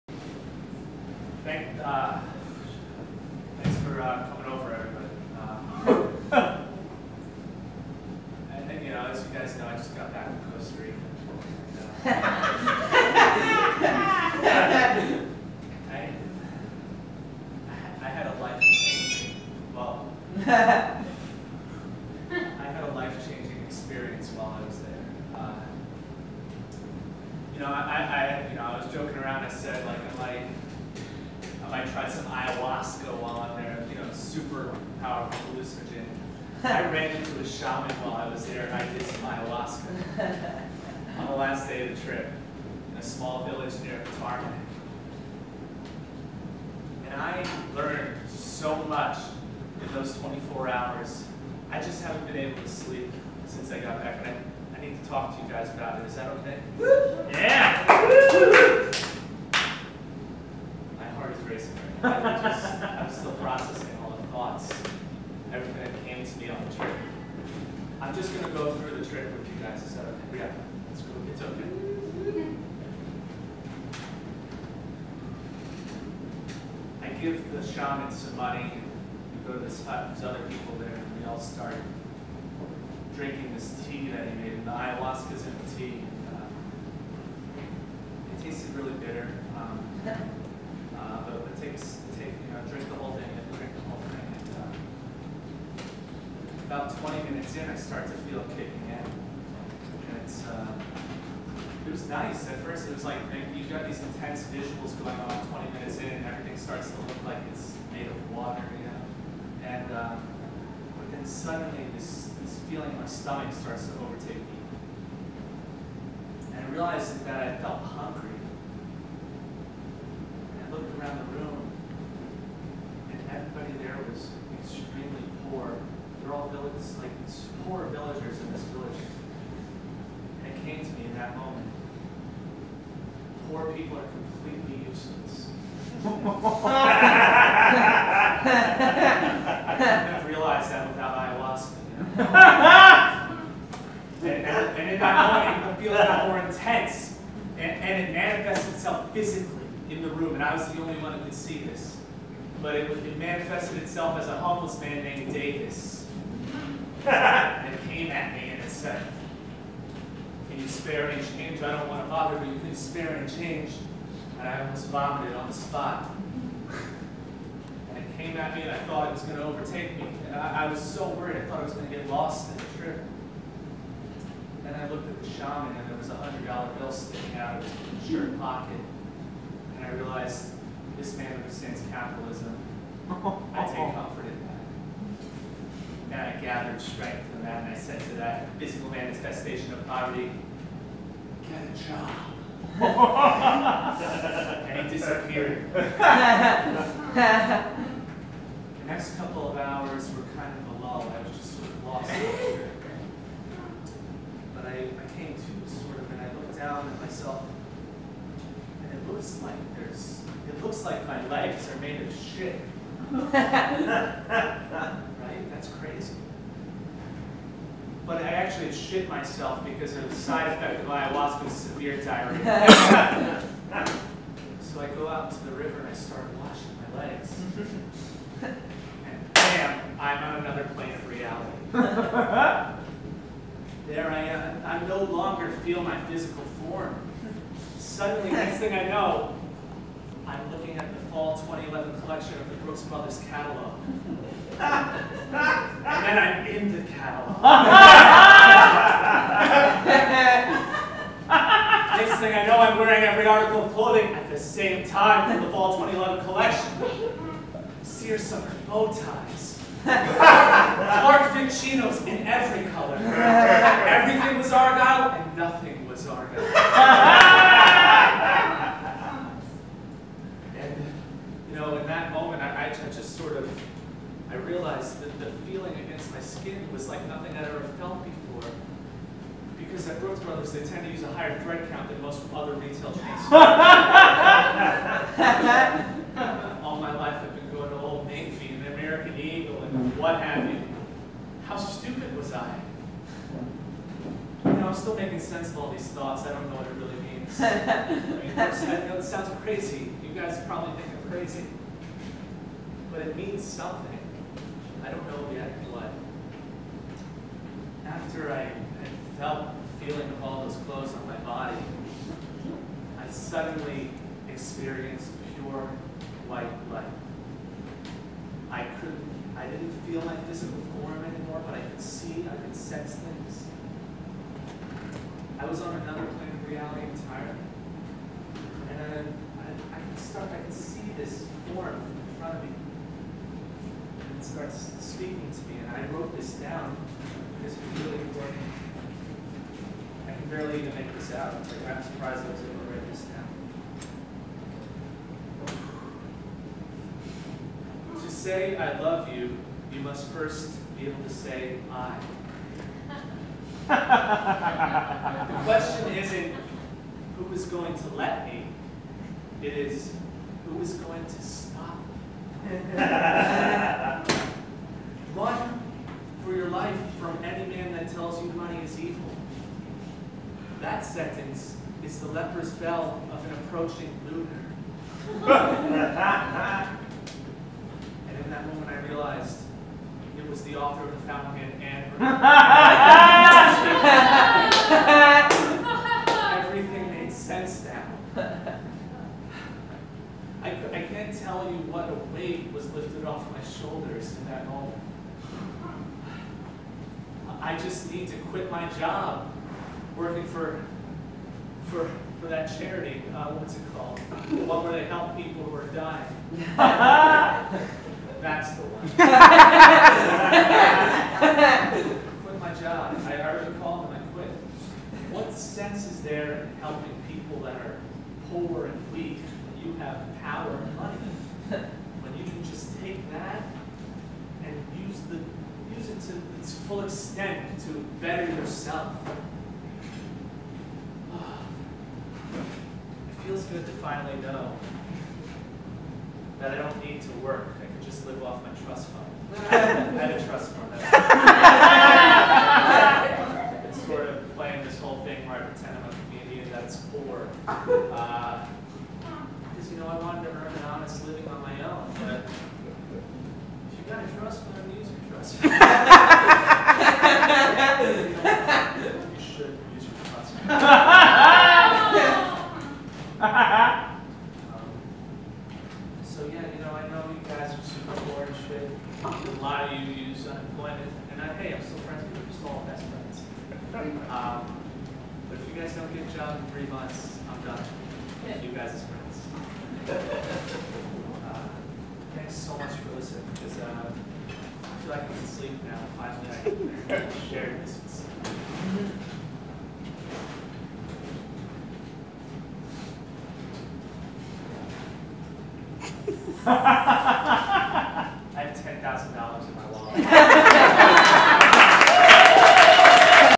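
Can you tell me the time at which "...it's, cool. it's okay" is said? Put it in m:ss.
1:10.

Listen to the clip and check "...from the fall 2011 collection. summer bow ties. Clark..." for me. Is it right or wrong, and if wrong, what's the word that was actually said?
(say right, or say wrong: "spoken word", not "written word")
right.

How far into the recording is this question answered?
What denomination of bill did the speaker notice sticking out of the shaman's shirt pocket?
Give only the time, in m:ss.
2:56.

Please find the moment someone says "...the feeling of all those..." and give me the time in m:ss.
5:09.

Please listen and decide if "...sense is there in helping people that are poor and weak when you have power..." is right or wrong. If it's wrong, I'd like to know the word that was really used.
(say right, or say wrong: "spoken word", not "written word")
right.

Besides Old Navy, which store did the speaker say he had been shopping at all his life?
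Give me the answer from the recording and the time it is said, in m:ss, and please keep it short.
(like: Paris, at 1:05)
American Eagle, at 4:48.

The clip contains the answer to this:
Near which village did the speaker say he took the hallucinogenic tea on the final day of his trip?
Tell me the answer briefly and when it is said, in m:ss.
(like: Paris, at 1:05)
Katarman, at 0:44.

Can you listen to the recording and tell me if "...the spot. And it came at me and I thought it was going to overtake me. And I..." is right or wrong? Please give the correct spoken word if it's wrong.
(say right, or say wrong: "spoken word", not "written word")
right.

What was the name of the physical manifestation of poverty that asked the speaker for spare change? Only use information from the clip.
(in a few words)
Davis.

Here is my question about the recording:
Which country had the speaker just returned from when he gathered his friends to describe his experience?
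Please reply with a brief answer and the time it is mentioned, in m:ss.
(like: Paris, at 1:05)
Costa Rica, at 0:10.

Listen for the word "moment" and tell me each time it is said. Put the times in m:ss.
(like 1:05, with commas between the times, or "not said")
2:11, 2:25, 6:18, 6:34.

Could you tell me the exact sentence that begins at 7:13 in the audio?
good to finally know that I don't need to work.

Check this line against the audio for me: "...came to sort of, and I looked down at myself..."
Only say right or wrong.
right.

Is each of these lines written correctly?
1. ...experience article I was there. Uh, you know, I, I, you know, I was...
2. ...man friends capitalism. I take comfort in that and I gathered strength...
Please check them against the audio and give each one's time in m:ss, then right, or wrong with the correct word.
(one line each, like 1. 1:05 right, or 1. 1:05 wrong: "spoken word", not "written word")
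1. 0:23 wrong: "while", not "article"
2. 3:01 wrong: "understands", not "friends".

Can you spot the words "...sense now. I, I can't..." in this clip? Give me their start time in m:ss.
6:27.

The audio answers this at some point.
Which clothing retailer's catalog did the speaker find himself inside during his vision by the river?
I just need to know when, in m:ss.
4:02.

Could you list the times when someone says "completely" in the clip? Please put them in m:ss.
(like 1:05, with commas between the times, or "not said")
2:14.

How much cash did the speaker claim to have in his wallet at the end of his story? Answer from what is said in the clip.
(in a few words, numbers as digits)
$10,000.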